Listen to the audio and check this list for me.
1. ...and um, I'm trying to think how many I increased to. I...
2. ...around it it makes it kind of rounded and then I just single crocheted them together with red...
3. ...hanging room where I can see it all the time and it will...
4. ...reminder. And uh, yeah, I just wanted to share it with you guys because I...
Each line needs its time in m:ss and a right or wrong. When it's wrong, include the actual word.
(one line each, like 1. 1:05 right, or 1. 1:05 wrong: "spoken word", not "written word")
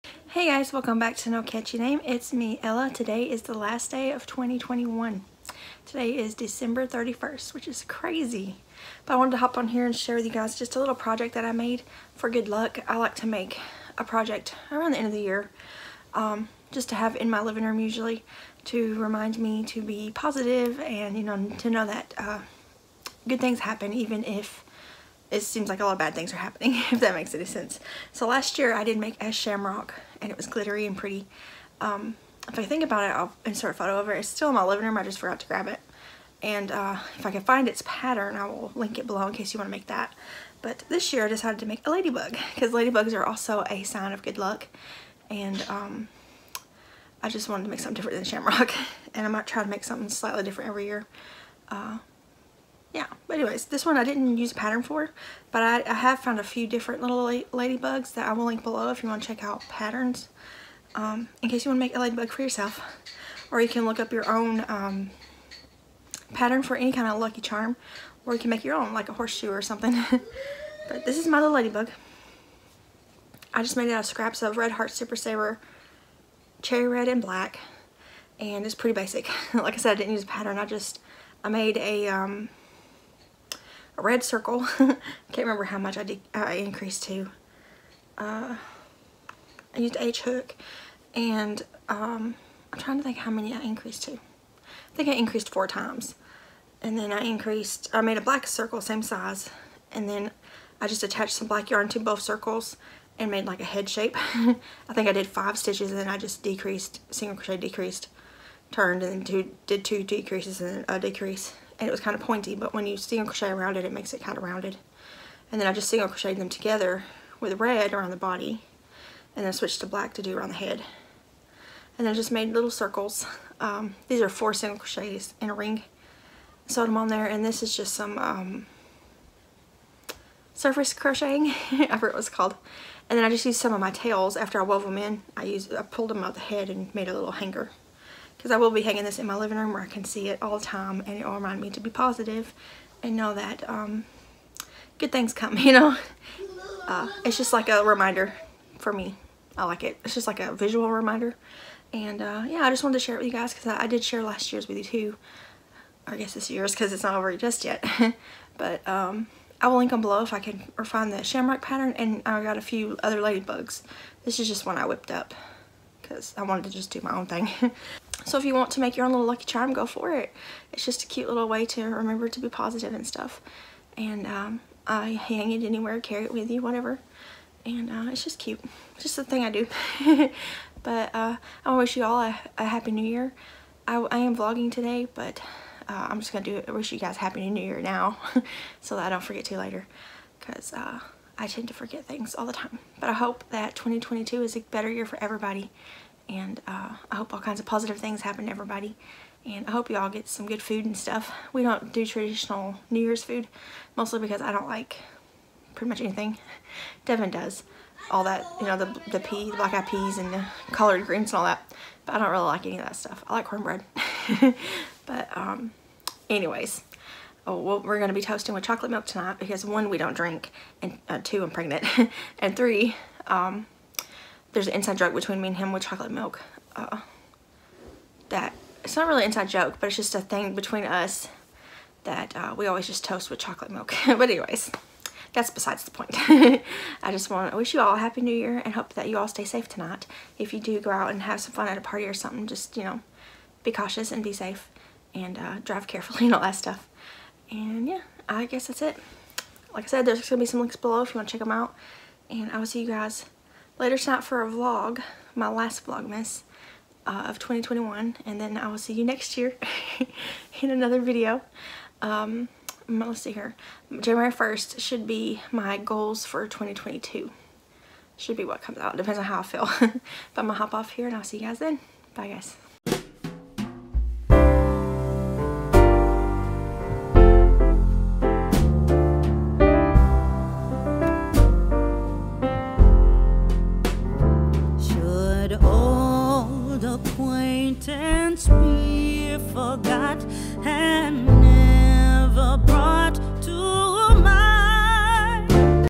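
1. 1:31 right
2. 1:53 right
3. 2:19 wrong: "living", not "hanging"
4. 2:30 right.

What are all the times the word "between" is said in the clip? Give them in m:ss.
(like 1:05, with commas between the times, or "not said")
3:45, 3:50.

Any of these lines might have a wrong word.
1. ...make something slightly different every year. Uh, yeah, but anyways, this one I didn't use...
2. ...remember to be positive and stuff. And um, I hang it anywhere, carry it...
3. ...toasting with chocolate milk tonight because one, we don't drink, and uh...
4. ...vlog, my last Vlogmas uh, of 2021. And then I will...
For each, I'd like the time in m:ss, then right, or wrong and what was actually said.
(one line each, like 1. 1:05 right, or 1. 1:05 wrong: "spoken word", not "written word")
1. 0:49 right
2. 2:51 right
3. 3:38 right
4. 4:14 right.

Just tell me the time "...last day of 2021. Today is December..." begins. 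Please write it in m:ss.
0:03.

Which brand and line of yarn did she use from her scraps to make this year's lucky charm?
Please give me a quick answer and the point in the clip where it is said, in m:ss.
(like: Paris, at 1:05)
Red Heart Super Saver, at 1:14.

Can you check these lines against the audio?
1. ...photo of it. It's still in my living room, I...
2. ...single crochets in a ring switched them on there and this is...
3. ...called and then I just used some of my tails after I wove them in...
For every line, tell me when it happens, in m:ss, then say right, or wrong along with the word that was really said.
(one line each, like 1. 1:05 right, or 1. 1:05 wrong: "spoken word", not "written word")
1. 0:33 right
2. 2:04 wrong: "sewed", not "switched"
3. 2:12 right.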